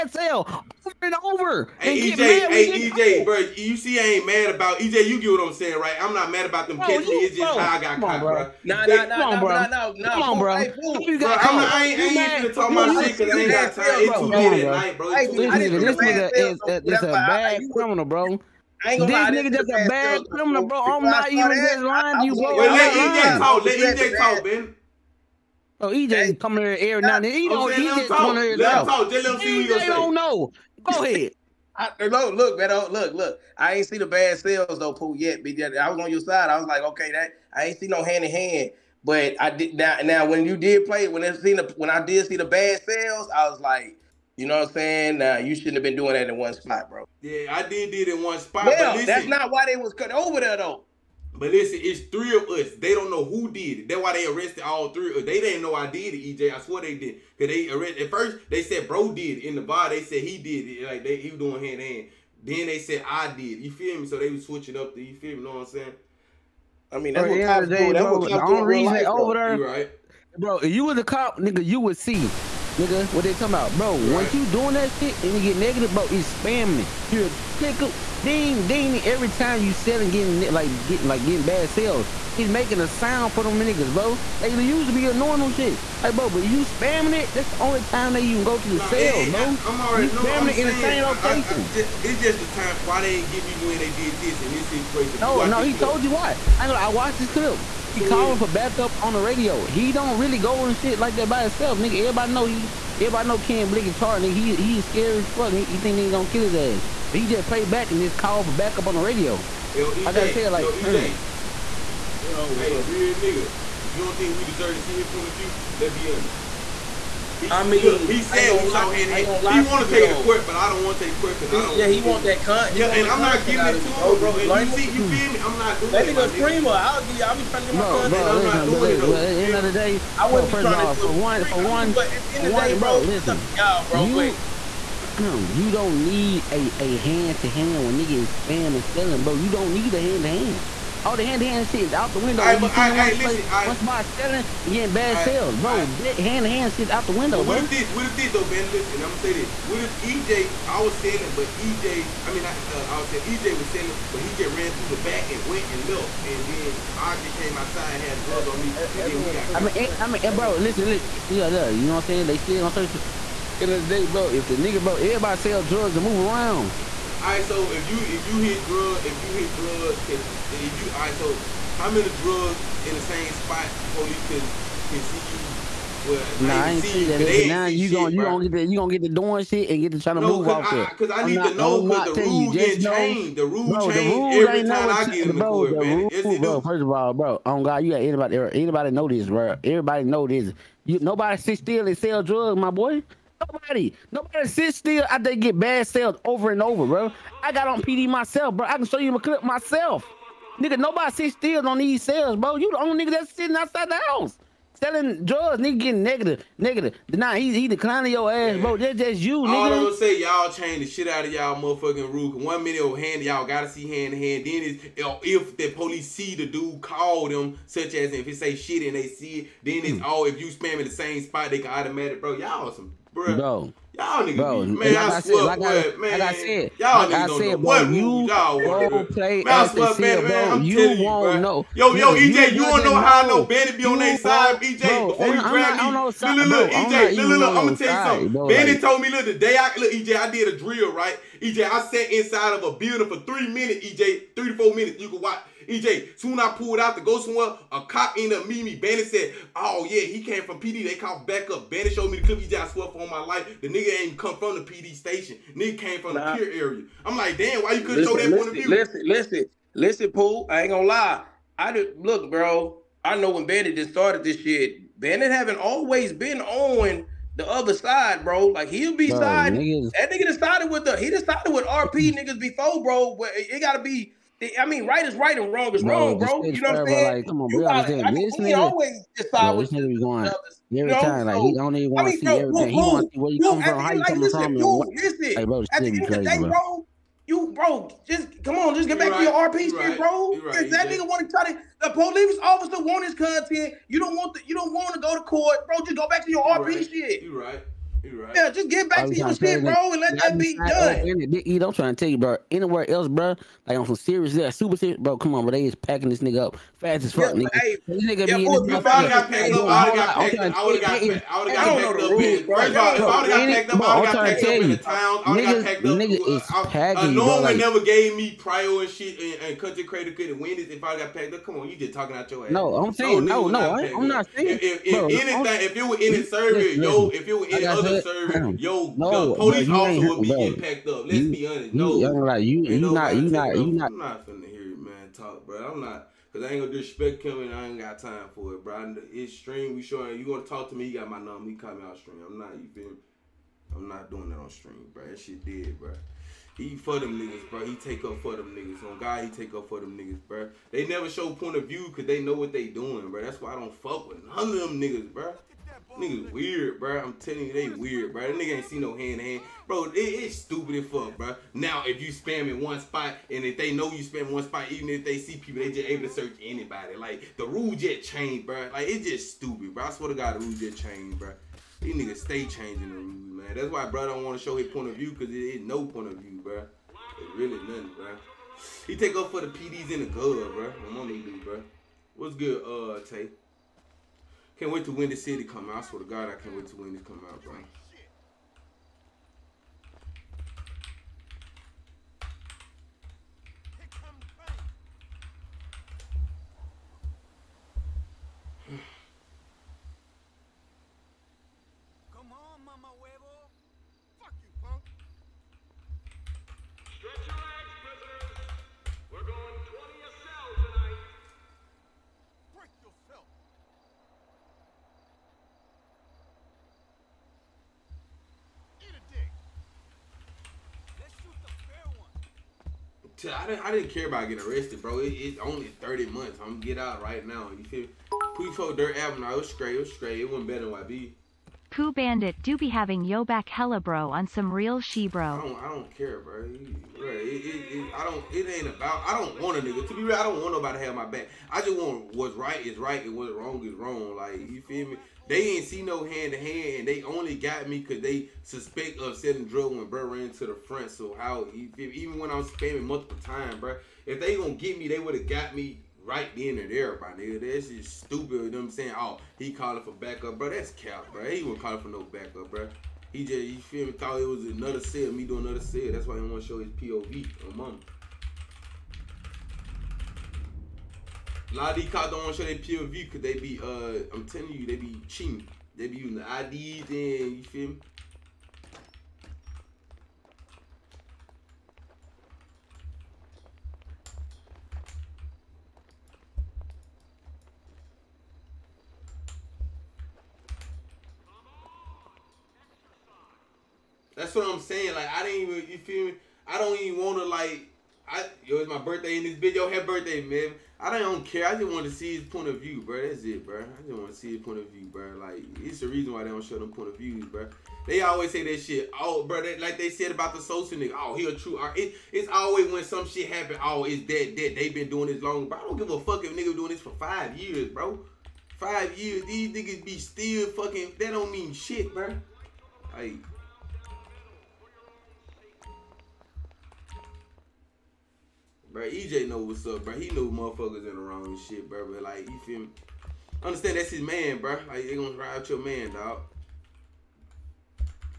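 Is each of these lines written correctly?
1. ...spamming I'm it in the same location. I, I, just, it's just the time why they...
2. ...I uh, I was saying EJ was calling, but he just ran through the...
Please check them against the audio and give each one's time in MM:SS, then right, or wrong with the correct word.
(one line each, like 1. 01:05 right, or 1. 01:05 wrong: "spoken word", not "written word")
1. 01:30 right
2. 02:32 wrong: "selling", not "calling".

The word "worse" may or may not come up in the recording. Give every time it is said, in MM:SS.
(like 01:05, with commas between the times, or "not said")
not said.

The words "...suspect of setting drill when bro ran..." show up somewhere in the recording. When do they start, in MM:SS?
07:28.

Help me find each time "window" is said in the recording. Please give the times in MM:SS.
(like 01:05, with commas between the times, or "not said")
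02:22, 02:27.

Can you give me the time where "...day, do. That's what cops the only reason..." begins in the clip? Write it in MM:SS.
01:07.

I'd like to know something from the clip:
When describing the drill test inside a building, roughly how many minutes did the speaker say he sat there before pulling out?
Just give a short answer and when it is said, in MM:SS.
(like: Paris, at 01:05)
3, at 04:03.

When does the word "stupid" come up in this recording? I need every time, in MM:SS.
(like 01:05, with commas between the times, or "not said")
06:00, 06:09, 07:38.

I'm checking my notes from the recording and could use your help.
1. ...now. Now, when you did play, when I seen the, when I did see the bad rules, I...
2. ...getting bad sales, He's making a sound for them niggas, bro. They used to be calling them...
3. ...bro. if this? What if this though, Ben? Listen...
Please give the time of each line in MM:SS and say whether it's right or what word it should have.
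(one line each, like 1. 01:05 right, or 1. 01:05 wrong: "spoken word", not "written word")
1. 00:39 wrong: "sales", not "rules"
2. 01:21 wrong: "annoying", not "calling"
3. 02:27 right.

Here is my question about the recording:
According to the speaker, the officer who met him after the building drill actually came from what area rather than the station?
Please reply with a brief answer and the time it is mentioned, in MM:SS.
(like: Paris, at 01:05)
the pier area, at 04:16.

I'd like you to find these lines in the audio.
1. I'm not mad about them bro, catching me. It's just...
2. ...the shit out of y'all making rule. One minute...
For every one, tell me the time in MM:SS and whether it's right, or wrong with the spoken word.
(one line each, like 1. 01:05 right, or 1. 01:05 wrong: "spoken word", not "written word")
1. 00:05 right
2. 03:30 wrong: "motherfucking", not "making".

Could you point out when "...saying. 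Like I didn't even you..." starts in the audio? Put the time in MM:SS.
08:14.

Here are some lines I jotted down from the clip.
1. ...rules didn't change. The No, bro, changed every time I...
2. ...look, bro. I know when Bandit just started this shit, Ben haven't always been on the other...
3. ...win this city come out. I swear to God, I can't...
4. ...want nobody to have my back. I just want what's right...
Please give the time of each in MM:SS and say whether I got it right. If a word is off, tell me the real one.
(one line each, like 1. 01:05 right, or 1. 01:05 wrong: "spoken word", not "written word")
1. 03:02 right
2. 04:22 wrong: "Bandit", not "Ben"
3. 06:24 right
4. 07:20 right.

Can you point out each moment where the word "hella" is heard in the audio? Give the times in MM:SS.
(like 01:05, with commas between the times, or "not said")
07:13.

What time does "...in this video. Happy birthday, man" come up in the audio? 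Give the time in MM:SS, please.
08:19.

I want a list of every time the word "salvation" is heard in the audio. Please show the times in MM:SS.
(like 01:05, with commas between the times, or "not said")
not said.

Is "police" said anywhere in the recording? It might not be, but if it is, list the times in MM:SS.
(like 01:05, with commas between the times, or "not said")
02:53, 03:35, 04:51, 05:29.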